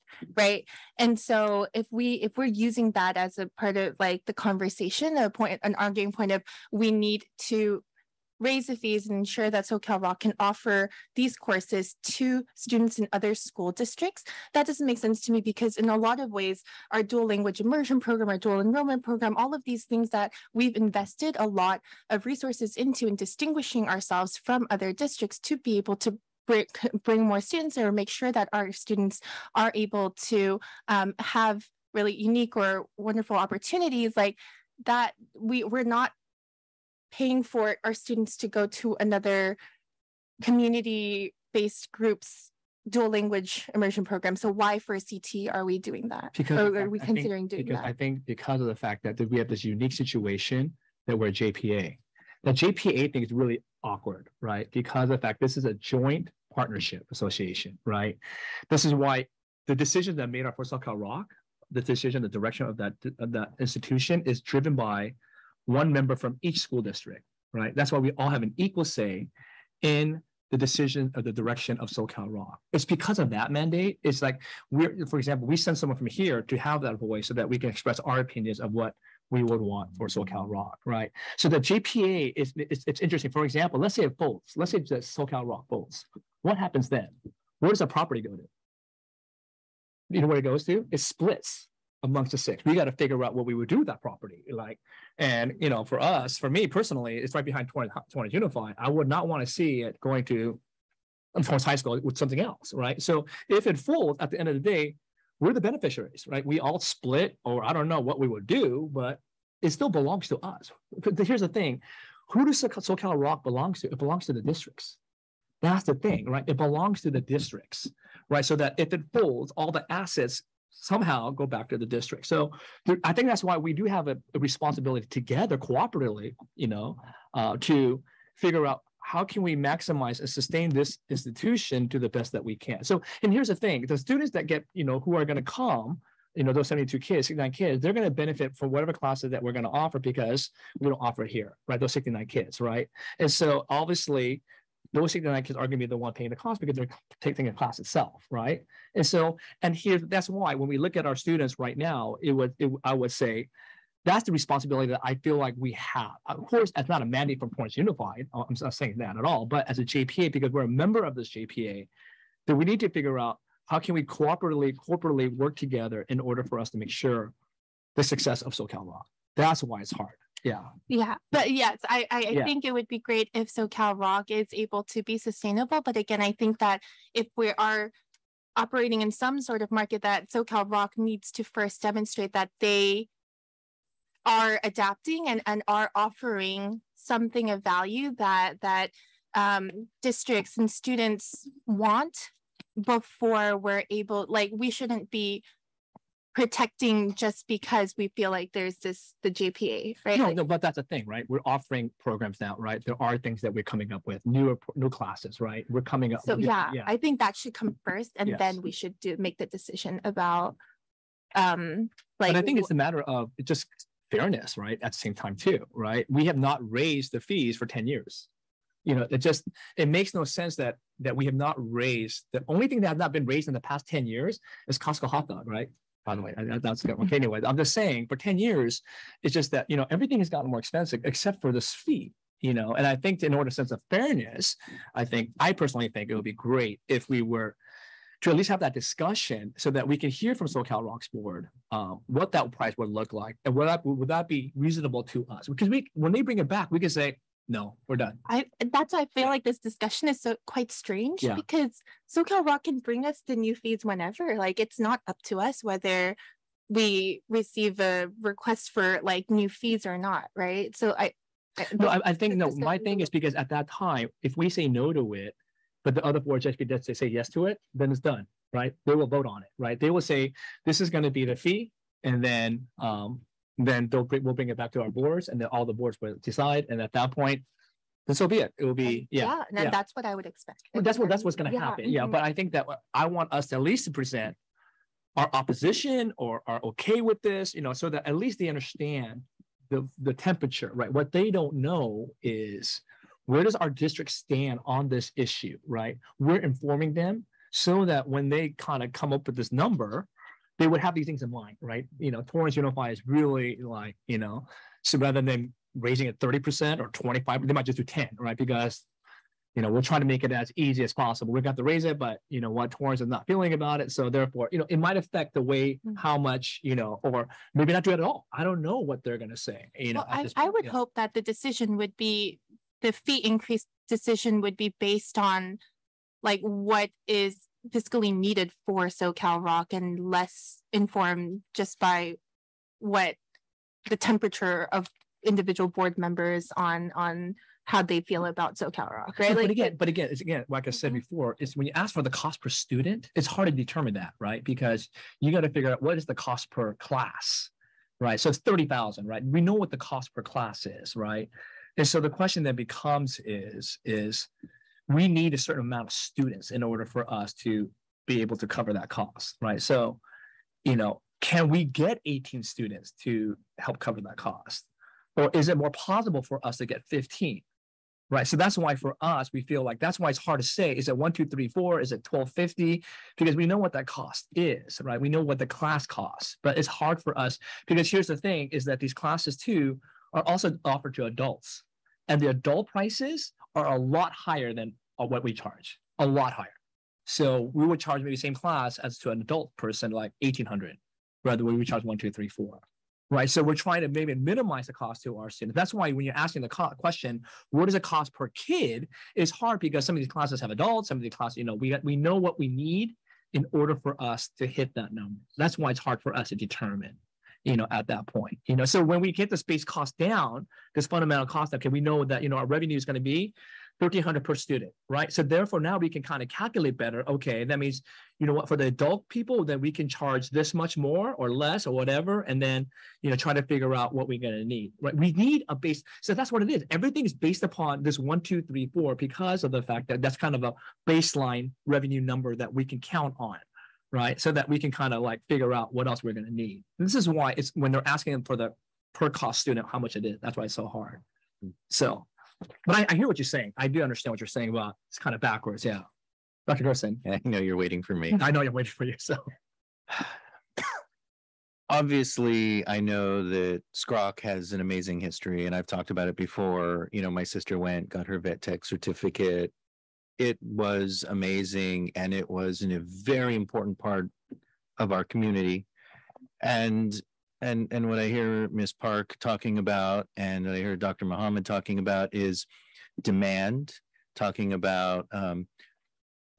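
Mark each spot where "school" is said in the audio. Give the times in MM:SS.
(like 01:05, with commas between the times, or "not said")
00:13, 01:06, 01:41.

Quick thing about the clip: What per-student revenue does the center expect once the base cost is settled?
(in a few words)
1300.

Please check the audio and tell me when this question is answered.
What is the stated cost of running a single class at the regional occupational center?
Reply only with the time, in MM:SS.
05:48.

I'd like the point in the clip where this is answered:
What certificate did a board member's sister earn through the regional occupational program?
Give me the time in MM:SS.
07:38.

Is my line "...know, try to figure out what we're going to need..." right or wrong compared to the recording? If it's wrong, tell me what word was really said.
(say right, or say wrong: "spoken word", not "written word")
right.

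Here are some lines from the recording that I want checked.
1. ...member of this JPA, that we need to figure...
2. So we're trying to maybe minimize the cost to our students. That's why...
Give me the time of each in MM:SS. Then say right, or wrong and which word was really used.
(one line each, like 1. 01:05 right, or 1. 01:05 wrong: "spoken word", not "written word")
1. 02:40 right
2. 06:33 right.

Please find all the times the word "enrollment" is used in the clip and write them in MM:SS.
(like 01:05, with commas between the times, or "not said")
00:18.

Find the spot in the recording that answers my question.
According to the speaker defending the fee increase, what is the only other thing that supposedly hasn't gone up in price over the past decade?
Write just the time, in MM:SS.
03:44.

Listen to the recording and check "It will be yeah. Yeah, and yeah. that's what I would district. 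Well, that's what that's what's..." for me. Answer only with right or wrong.
wrong.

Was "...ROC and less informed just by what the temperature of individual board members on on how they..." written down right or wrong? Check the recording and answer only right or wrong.
right.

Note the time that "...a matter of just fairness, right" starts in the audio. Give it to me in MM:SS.
03:32.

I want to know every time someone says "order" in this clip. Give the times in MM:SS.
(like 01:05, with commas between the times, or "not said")
02:46, 03:53, 05:56, 06:43.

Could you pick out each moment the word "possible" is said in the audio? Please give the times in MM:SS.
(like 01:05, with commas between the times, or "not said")
05:10, 06:05.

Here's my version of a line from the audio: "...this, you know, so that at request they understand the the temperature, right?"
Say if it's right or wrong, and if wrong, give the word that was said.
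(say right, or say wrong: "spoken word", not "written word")
wrong: "least", not "request".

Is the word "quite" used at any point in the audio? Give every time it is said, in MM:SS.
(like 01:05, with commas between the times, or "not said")
04:10.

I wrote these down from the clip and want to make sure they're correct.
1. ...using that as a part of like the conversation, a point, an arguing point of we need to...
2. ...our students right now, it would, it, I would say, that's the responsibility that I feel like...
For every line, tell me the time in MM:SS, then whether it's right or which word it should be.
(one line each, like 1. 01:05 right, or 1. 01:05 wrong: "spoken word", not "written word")
1. 00:02 right
2. 02:31 right.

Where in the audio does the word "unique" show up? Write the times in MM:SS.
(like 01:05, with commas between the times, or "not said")
00:32, 00:49.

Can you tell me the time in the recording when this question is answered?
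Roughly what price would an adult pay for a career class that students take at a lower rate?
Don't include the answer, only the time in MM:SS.
06:30.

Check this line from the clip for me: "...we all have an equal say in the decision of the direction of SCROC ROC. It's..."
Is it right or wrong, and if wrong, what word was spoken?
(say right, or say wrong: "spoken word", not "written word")
wrong: "SoCal", not "SCROC".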